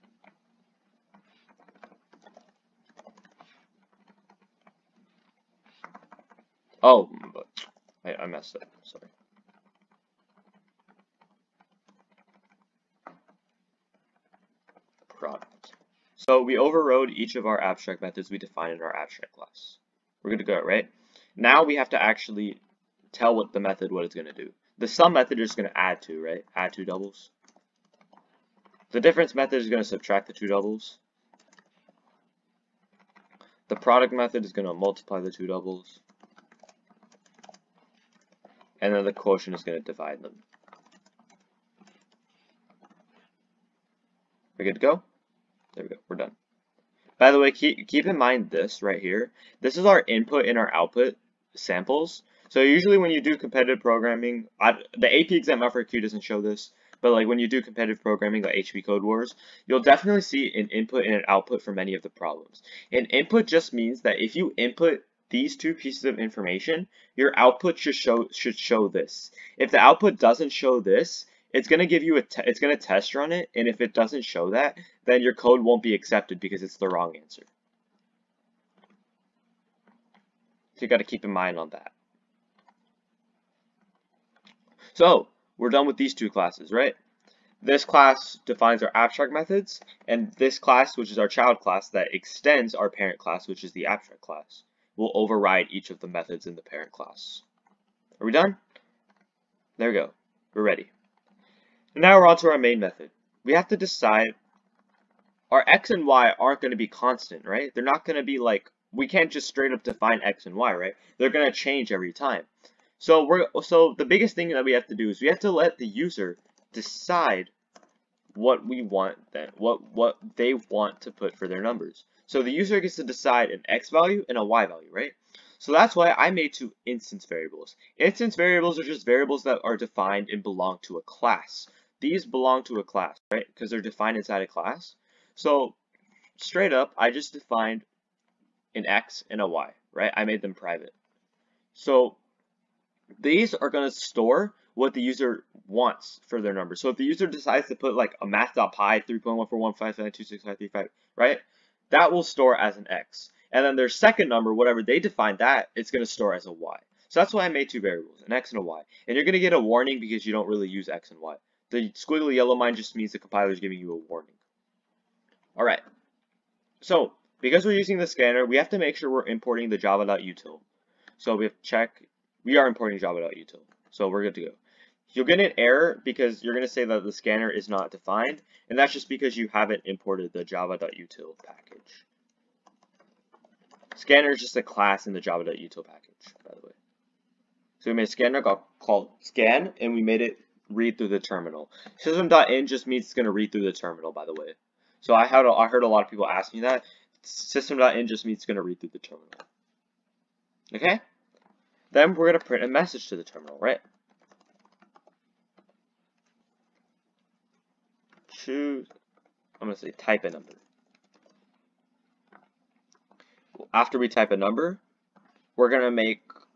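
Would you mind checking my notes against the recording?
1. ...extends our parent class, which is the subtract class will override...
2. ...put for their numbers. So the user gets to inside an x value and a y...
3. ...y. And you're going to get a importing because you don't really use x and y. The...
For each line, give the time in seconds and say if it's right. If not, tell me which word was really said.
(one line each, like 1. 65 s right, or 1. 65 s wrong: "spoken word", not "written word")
1. 92 s wrong: "abstract", not "subtract"
2. 121 s wrong: "decide", not "inside"
3. 158 s wrong: "warning", not "importing".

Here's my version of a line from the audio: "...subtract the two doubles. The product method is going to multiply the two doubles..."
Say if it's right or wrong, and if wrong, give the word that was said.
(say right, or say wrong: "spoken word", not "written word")
right.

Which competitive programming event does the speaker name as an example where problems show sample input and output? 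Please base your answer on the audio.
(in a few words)
HP Code Wars.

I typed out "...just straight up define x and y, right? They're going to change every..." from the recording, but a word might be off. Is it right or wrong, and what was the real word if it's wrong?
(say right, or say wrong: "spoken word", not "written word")
right.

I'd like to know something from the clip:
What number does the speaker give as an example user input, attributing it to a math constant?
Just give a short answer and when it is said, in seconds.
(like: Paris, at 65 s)
3.141552655, at 149 s.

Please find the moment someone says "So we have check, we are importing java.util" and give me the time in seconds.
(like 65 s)
171 s.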